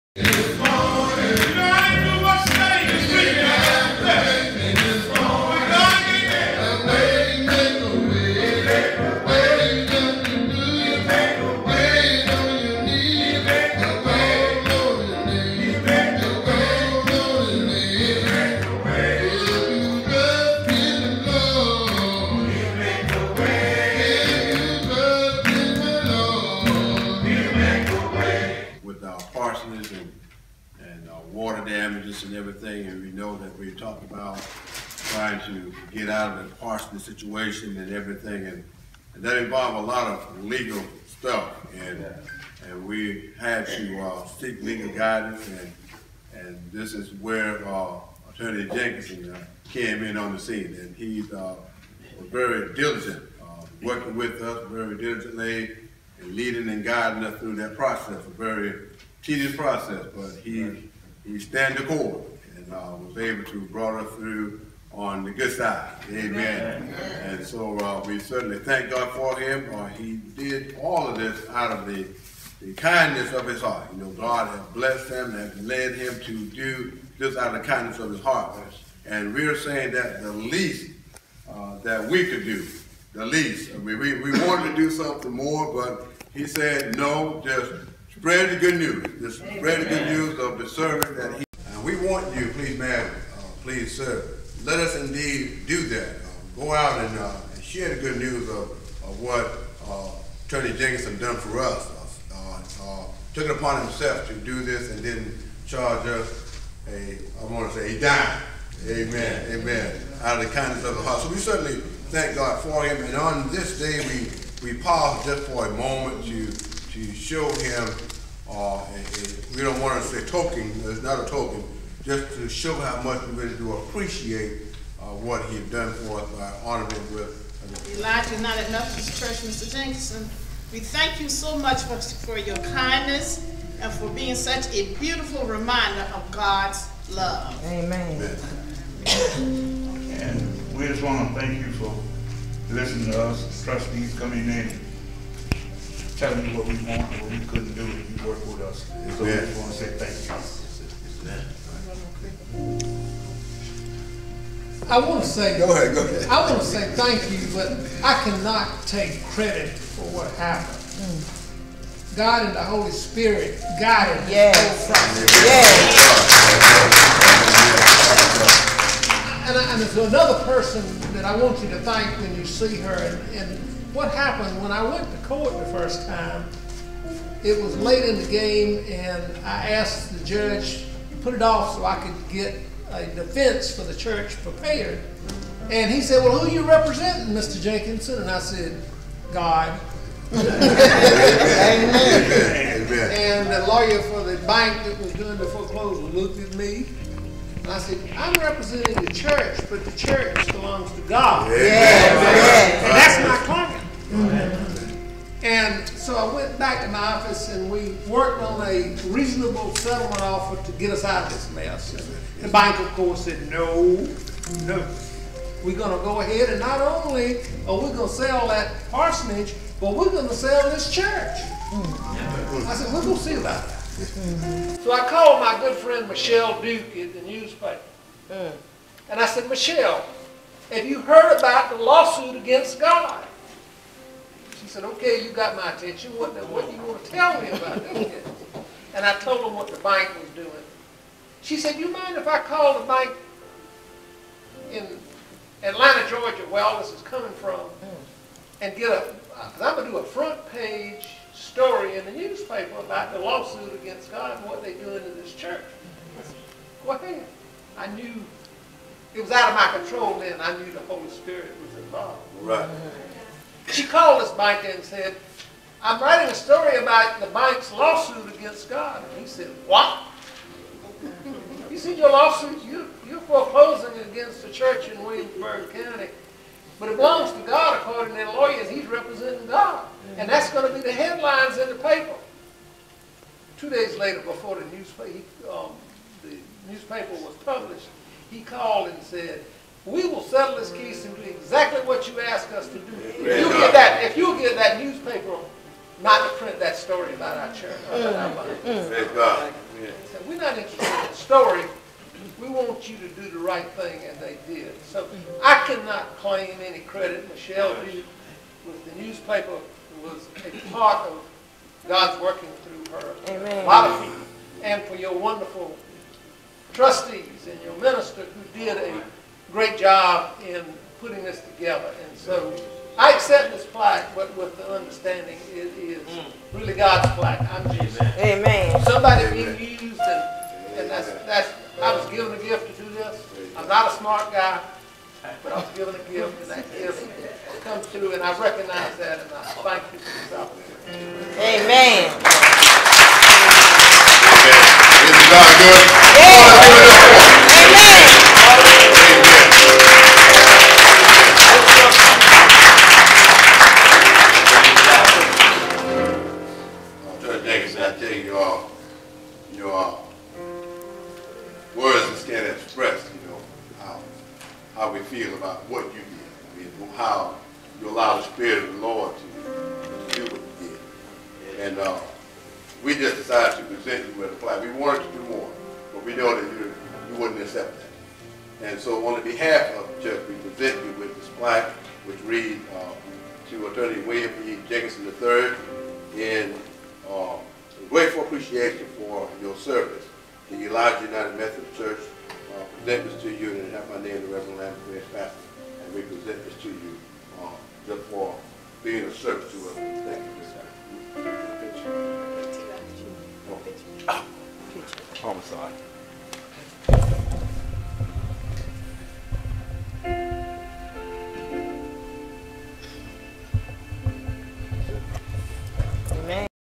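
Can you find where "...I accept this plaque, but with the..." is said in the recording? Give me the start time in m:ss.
5:22.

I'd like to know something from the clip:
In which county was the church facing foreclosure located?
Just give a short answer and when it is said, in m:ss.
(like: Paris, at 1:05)
Williamsburg County, at 4:35.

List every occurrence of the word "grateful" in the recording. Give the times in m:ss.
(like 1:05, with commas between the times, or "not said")
6:27.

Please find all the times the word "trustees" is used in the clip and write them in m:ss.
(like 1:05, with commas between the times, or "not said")
2:23, 5:16.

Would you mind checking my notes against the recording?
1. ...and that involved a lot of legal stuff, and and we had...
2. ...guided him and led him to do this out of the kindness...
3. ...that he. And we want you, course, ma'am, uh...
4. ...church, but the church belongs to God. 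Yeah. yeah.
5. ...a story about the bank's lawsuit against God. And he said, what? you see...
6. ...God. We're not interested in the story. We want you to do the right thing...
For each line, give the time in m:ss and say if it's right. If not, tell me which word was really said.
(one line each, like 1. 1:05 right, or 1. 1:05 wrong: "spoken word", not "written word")
1. 0:39 right
2. 1:14 wrong: "blessed", not "guided"
3. 1:31 wrong: "please", not "course"
4. 3:19 right
5. 4:26 right
6. 4:59 right.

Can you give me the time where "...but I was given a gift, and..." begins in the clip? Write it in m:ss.
5:35.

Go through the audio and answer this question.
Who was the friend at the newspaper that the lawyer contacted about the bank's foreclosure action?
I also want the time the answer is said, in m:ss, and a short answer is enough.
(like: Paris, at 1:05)
Michelle Duke, at 3:46.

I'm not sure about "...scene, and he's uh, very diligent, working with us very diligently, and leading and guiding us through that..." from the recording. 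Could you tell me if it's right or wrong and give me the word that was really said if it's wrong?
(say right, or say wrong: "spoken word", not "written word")
right.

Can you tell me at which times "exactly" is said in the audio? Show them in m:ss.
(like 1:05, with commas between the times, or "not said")
4:51.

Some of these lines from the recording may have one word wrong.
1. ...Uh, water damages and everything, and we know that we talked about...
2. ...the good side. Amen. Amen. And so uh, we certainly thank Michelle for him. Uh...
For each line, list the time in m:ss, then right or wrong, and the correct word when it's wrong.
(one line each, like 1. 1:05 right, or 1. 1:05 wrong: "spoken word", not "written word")
1. 0:31 right
2. 1:05 wrong: "God", not "Michelle".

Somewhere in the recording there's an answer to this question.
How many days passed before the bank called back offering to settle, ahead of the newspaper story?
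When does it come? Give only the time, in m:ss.
4:43.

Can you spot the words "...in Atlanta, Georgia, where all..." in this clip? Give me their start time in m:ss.
4:04.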